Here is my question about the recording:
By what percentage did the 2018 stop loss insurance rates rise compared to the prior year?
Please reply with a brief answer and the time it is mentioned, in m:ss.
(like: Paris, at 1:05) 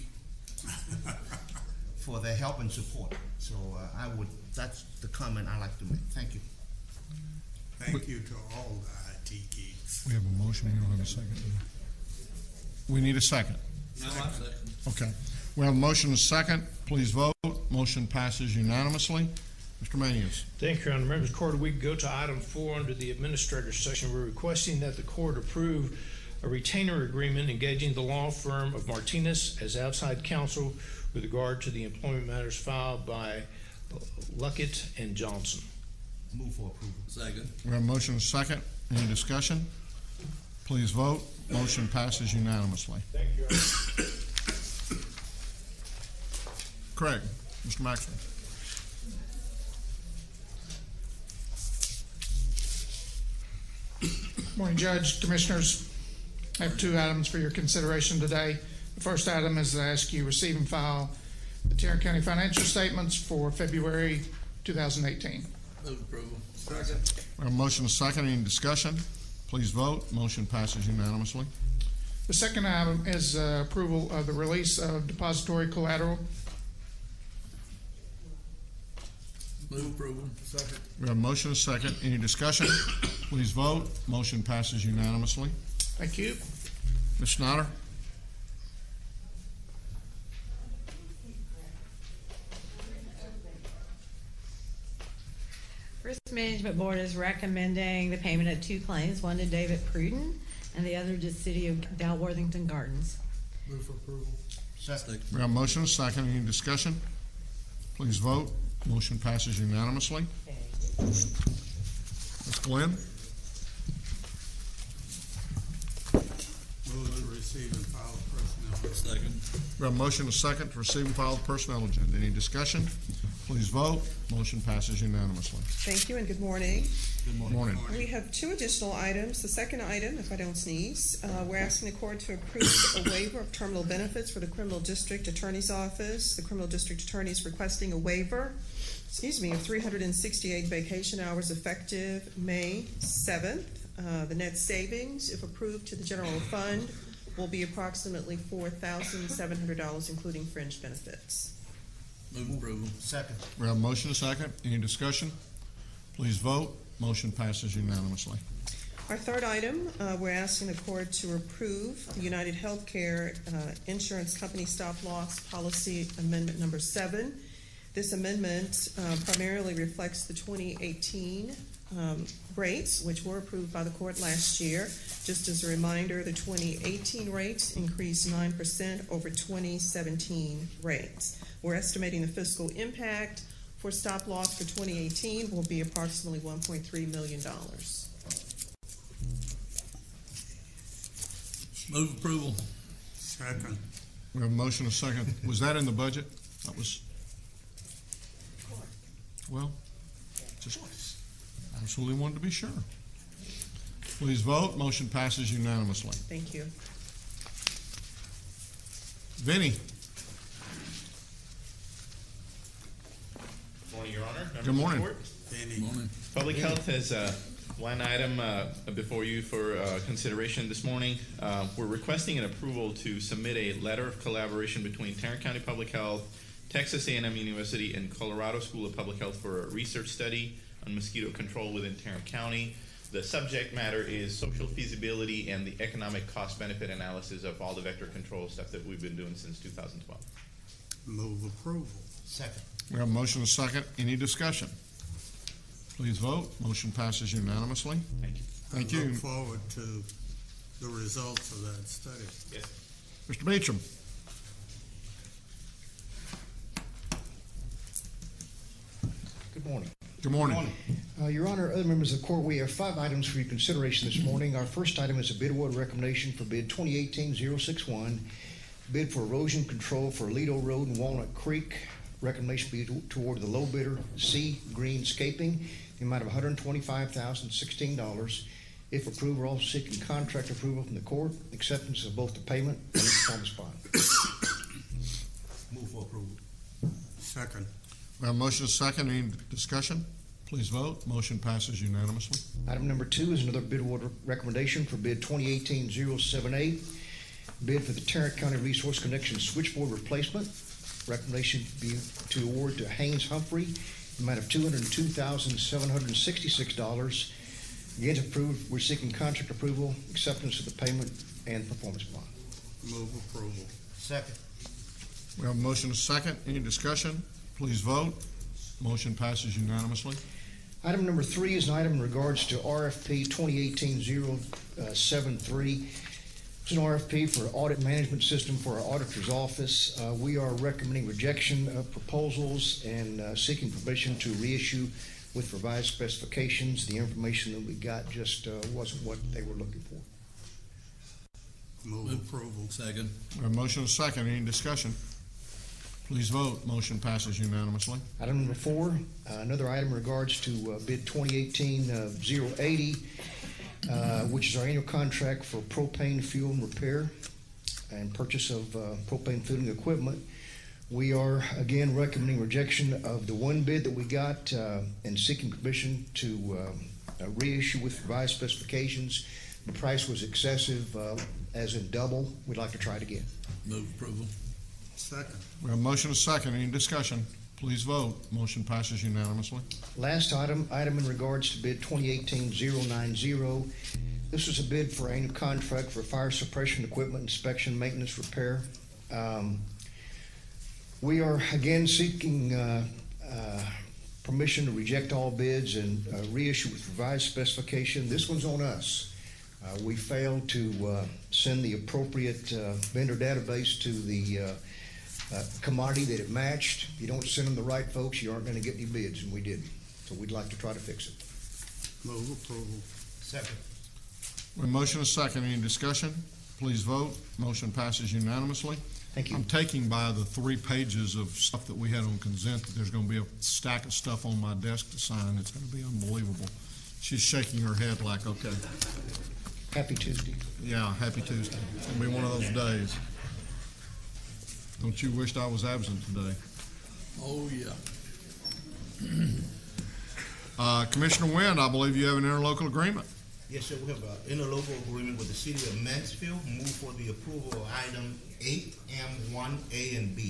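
9%, at 2:58.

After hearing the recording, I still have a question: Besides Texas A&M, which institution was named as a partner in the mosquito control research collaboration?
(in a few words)
Colorado School of Public Health.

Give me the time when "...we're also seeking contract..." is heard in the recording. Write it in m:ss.
4:39.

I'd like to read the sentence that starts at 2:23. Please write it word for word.
Uh, The net savings, if approved to the general fund, will be approximately $4,700, including fringe benefits.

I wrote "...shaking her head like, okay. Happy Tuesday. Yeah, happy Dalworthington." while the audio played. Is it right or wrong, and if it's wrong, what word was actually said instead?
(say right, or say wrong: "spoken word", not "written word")
wrong: "Tuesday", not "Dalworthington".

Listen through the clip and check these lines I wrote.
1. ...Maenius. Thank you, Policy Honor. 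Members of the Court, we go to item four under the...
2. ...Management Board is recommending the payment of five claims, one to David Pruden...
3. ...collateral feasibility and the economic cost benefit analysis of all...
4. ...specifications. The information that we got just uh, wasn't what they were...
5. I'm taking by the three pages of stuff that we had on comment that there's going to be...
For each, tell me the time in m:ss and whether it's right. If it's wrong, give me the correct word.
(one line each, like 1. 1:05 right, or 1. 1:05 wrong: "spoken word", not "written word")
1. 0:19 wrong: "Your", not "Policy"
2. 1:36 wrong: "two", not "five"
3. 3:54 wrong: "social", not "collateral"
4. 5:35 right
5. 6:59 wrong: "consent", not "comment".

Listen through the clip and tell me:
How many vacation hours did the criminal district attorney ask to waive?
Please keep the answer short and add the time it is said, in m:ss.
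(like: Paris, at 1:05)
368, at 2:19.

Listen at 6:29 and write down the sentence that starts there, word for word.
Um, We are again seeking uh, uh, permission to reject all bids and uh, reissue with revised specification.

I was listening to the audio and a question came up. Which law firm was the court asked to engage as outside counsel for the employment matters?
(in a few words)
Martinez.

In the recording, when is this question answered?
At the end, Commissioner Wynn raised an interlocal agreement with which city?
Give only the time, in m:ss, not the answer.
7:25.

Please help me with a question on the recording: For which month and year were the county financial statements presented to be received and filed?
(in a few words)
February 2018.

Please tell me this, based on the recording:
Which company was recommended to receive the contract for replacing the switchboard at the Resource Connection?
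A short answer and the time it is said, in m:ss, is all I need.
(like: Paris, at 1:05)
Haynes Humphrey, at 5:02.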